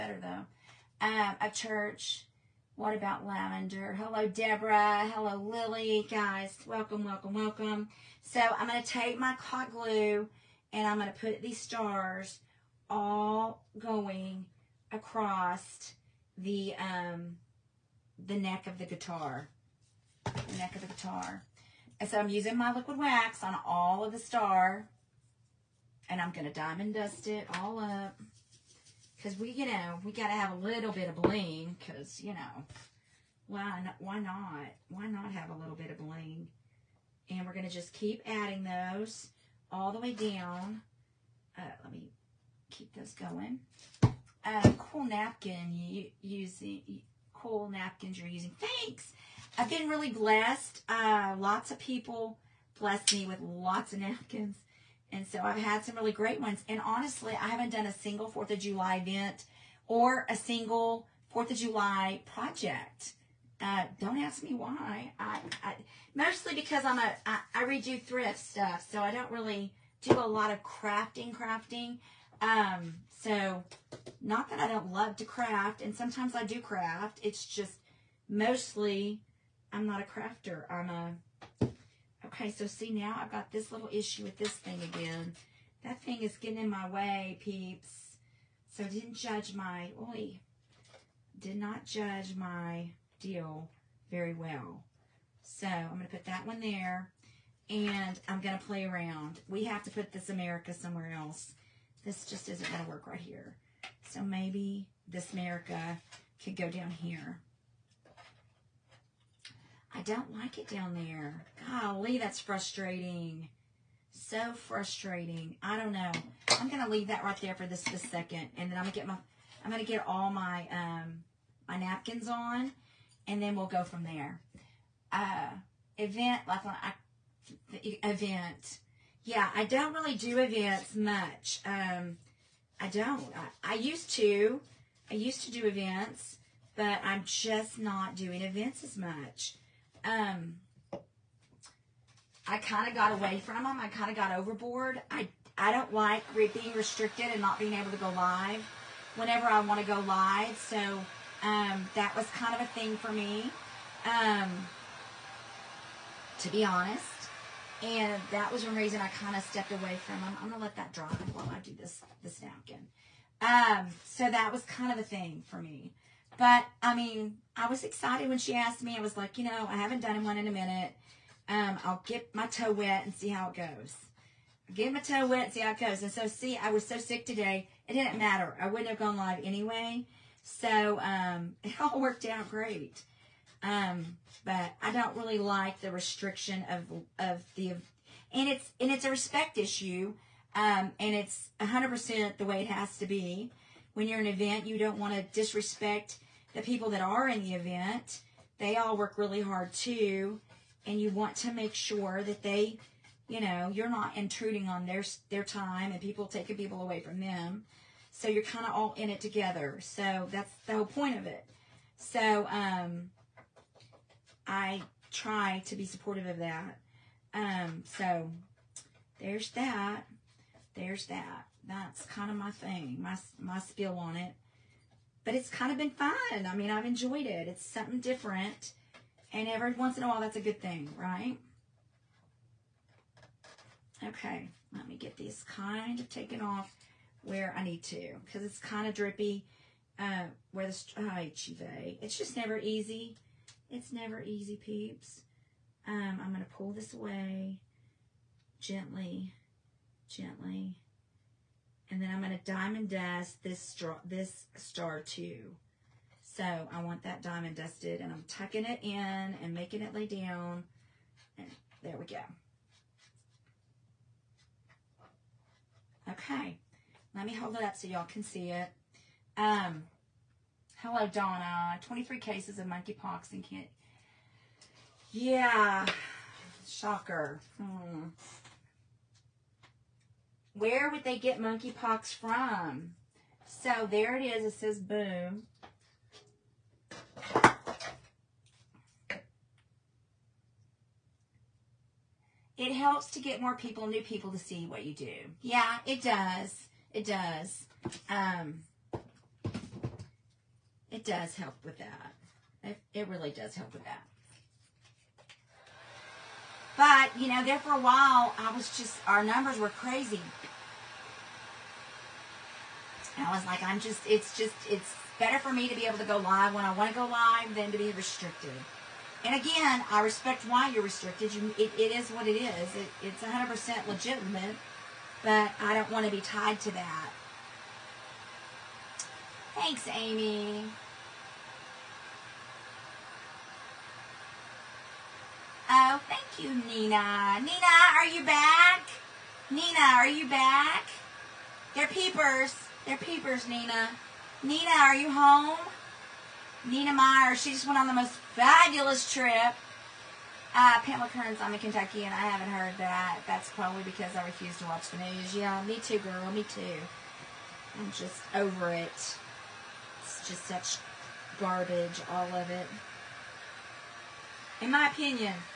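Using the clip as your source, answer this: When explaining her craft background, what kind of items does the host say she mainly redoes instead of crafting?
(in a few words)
thrift stuff.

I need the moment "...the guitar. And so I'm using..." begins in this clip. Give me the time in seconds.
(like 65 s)
20 s.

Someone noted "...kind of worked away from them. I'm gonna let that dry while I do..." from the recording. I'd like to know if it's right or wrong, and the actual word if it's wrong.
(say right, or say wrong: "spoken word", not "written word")
wrong: "stepped", not "worked".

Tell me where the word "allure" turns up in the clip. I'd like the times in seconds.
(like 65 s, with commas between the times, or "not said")
not said.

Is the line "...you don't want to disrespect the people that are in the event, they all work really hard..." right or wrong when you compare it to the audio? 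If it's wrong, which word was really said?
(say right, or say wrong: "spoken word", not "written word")
right.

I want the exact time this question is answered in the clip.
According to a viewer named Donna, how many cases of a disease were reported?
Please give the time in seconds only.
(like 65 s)
271 s.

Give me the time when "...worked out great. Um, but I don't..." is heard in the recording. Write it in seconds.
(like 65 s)
181 s.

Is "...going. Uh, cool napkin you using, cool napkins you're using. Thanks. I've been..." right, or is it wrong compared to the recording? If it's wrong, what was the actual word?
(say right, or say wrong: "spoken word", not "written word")
right.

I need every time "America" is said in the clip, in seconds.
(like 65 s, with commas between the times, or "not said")
100 s, 105 s.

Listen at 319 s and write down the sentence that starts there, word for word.
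And again, I respect why you're restricted.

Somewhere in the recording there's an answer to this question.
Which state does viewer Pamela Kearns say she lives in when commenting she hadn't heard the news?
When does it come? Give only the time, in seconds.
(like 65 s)
351 s.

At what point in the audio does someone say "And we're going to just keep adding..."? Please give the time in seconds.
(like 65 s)
37 s.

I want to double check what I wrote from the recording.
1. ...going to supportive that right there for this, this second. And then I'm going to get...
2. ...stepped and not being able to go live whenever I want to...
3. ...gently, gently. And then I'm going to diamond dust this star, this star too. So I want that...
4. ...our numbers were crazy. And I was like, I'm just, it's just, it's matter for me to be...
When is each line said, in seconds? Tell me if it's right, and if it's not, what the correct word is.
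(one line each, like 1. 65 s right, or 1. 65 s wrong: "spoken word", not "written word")
1. 116 s wrong: "leave", not "supportive"
2. 146 s wrong: "restricted", not "stepped"
3. 248 s right
4. 309 s wrong: "better", not "matter".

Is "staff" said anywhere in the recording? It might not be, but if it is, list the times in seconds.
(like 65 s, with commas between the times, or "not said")
not said.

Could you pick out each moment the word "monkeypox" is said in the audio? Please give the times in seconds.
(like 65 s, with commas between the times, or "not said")
272 s, 281 s.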